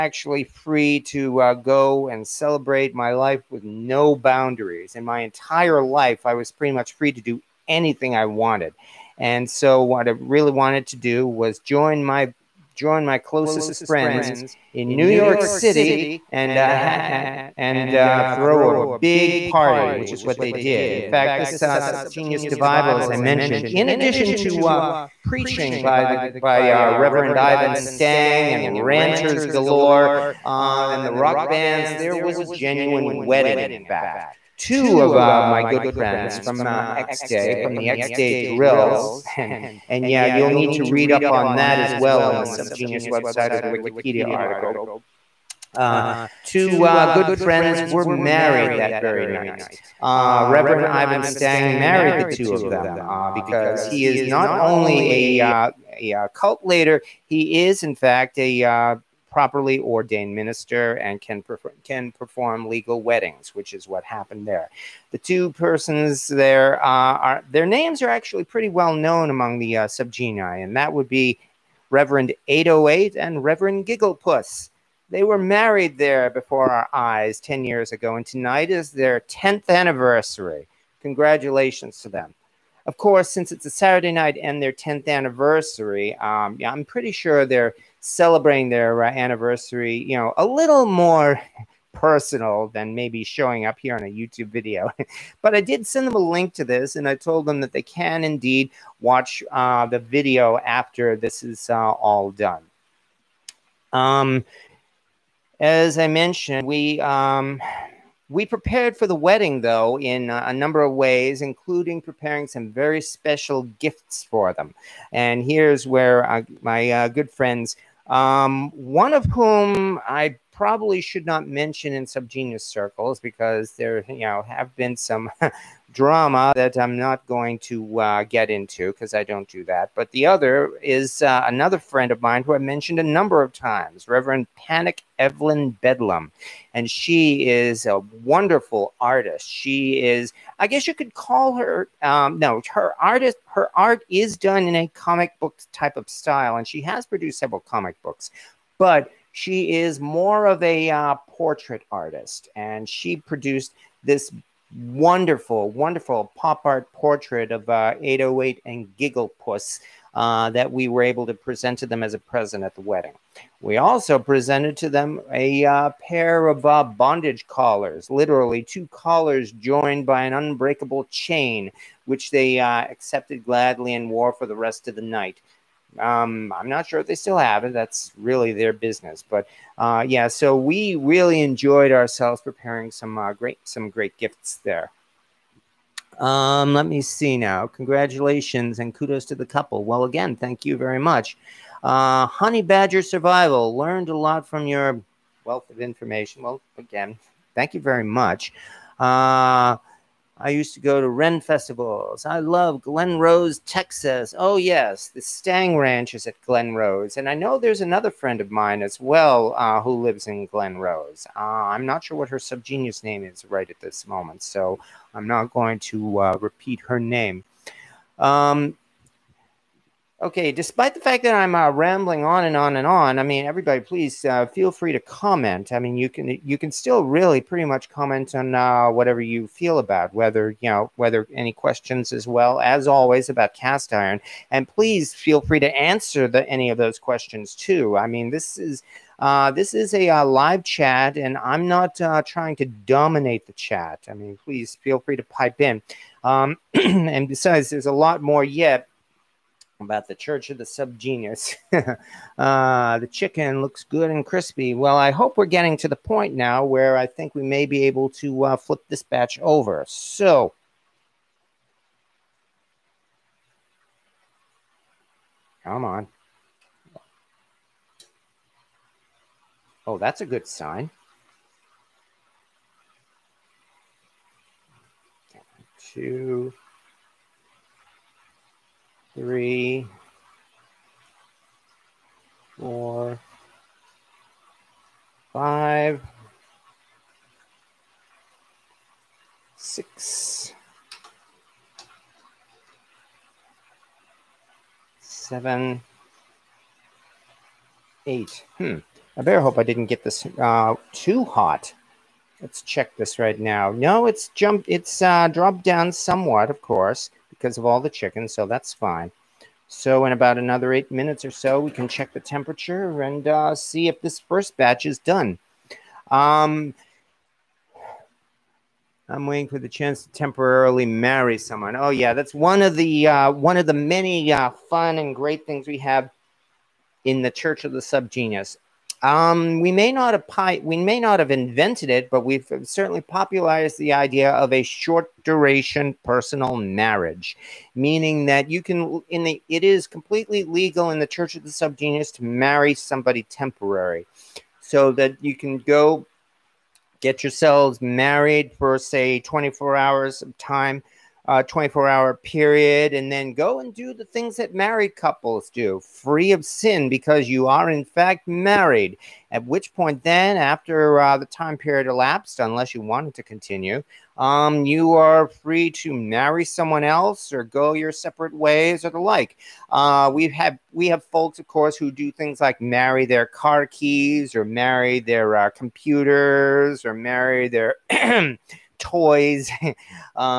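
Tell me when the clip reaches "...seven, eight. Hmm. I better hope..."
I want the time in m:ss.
4:54.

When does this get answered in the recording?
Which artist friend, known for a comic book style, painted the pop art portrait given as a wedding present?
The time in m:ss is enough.
2:14.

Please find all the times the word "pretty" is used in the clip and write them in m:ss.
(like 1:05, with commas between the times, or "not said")
0:06, 1:08, 1:26, 3:47.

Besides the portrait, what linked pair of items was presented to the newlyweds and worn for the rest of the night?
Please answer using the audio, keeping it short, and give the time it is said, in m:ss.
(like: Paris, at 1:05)
bondage collars, at 2:46.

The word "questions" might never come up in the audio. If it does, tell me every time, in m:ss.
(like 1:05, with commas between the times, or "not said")
3:51, 3:56.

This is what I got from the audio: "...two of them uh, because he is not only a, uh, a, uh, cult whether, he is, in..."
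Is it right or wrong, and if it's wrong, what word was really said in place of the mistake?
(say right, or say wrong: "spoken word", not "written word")
wrong: "leader", not "whether".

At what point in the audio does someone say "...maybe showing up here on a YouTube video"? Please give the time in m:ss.
1:32.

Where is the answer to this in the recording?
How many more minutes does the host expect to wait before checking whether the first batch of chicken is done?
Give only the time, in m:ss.
5:10.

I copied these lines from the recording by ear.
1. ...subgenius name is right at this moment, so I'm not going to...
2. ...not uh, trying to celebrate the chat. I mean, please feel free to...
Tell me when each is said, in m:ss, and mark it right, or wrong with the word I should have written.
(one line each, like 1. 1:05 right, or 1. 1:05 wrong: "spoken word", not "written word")
1. 3:32 right
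2. 4:01 wrong: "dominate", not "celebrate".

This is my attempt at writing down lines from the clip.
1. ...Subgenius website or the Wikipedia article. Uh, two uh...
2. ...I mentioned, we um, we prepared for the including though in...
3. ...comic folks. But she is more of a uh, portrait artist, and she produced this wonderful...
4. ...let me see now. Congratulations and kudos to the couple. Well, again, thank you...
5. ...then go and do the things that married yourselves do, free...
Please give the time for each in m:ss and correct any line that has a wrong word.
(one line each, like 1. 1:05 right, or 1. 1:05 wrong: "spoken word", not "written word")
1. 0:42 right
2. 1:45 wrong: "wedding", not "including"
3. 2:27 wrong: "books", not "folks"
4. 3:06 right
5. 5:53 wrong: "couples", not "yourselves".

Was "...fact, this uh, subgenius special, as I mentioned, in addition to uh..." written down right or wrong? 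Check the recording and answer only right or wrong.
wrong.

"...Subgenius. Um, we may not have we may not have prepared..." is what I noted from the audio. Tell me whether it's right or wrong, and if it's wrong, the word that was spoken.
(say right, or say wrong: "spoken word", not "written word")
wrong: "invented", not "prepared".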